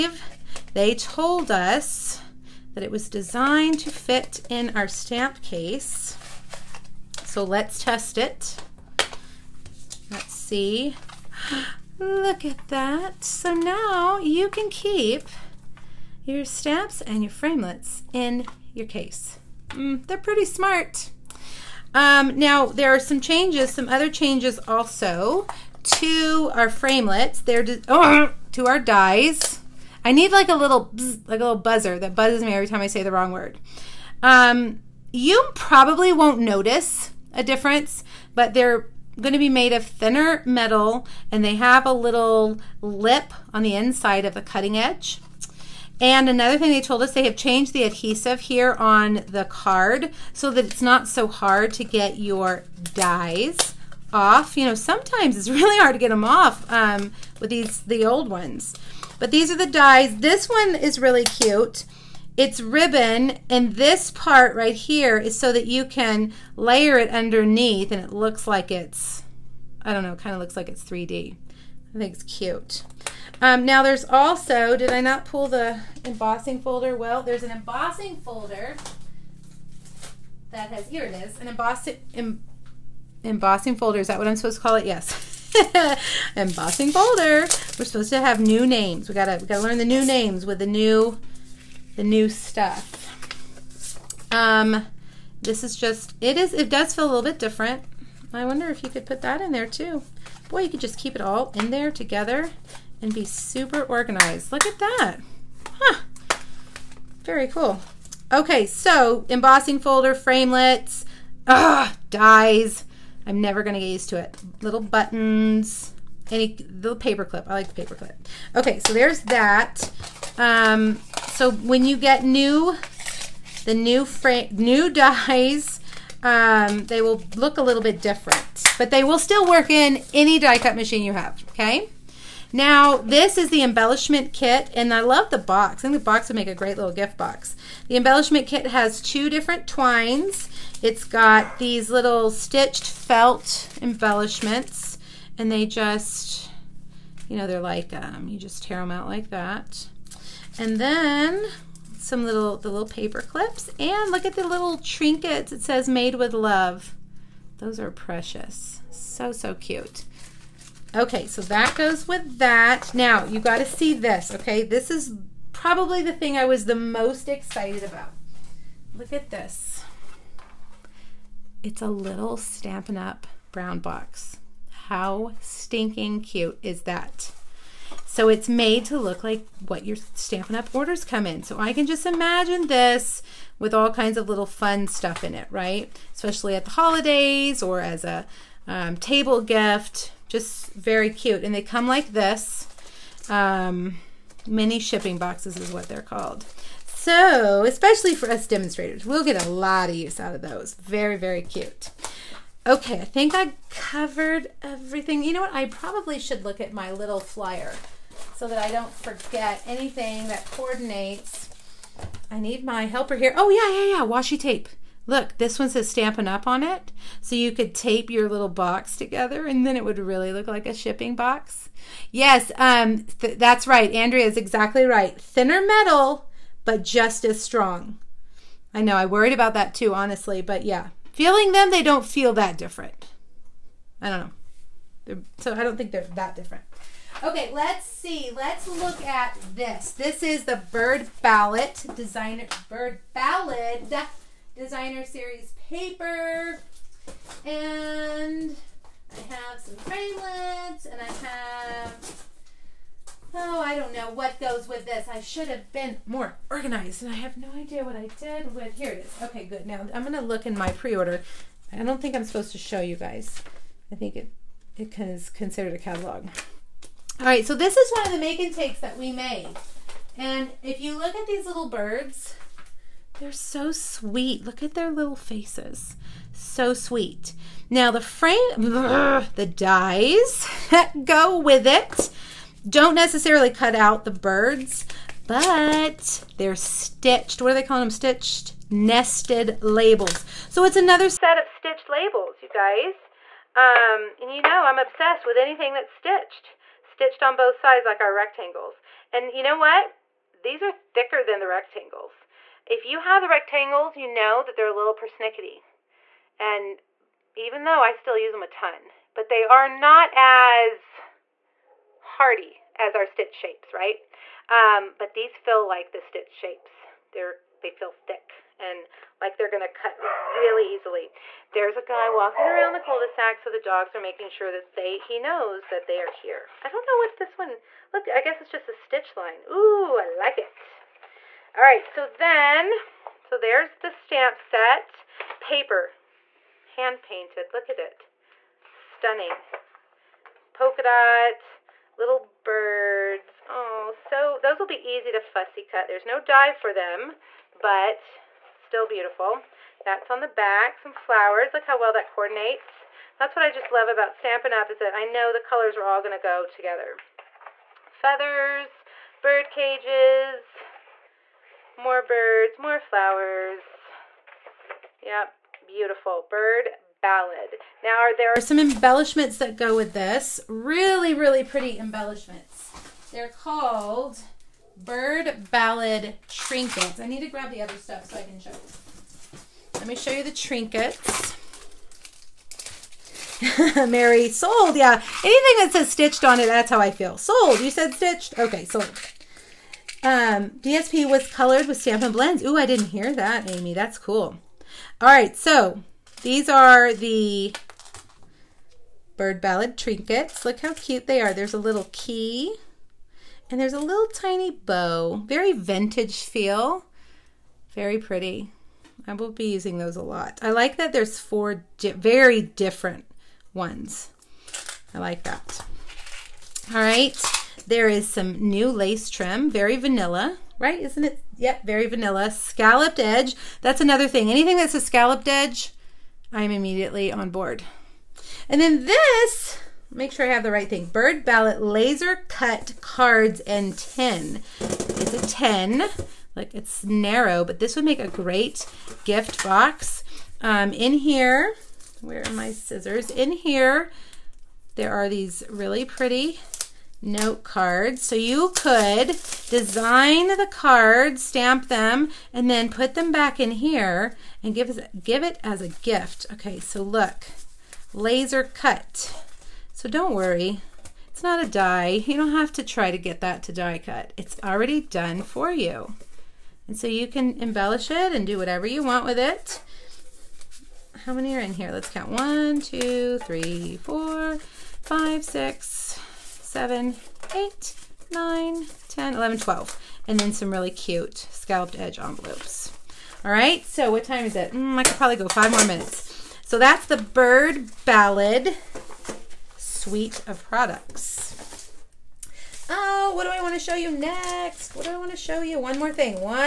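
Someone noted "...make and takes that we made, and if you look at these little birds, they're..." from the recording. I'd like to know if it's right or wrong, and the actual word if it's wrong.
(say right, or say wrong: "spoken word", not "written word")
right.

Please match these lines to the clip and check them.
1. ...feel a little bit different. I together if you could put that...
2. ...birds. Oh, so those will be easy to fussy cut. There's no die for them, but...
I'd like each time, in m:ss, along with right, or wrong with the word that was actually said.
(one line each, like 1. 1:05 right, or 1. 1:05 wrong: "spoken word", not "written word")
1. 1:36 wrong: "wonder", not "together"
2. 5:42 right.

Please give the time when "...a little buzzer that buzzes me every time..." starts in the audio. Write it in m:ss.
0:31.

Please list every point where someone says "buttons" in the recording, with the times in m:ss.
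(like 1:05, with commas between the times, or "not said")
1:54.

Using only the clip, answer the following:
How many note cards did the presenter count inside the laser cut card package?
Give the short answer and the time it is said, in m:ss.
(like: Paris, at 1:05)
12, at 7:59.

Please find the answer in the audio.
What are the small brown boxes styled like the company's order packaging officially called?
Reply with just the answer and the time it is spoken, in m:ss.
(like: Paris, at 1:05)
Mini shipping boxes, at 3:14.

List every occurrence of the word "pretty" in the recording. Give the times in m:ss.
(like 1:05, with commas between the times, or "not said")
0:20, 6:11, 6:47, 7:25.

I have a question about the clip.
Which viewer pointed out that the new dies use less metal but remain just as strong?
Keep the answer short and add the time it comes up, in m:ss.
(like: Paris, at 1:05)
Andrea, at 3:43.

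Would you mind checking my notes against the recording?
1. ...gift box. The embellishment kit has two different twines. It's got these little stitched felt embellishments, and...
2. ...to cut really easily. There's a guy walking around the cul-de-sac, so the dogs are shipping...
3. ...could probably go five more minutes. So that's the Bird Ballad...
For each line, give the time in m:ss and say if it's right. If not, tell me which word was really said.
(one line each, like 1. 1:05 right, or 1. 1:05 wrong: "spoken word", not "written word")
1. 2:16 right
2. 5:19 wrong: "making", not "shipping"
3. 8:04 right.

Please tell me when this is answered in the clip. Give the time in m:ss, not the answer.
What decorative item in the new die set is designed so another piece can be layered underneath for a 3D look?
1:02.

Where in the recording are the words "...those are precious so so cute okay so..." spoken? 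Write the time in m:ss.
2:37.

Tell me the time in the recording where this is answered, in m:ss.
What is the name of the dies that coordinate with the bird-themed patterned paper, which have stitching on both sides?
4:47.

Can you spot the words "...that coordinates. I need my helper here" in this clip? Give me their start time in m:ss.
3:30.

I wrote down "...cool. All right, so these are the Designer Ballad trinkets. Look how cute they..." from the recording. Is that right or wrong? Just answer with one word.
wrong.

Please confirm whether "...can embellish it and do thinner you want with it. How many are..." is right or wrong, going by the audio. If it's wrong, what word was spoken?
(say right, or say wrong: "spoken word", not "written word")
wrong: "whatever", not "thinner".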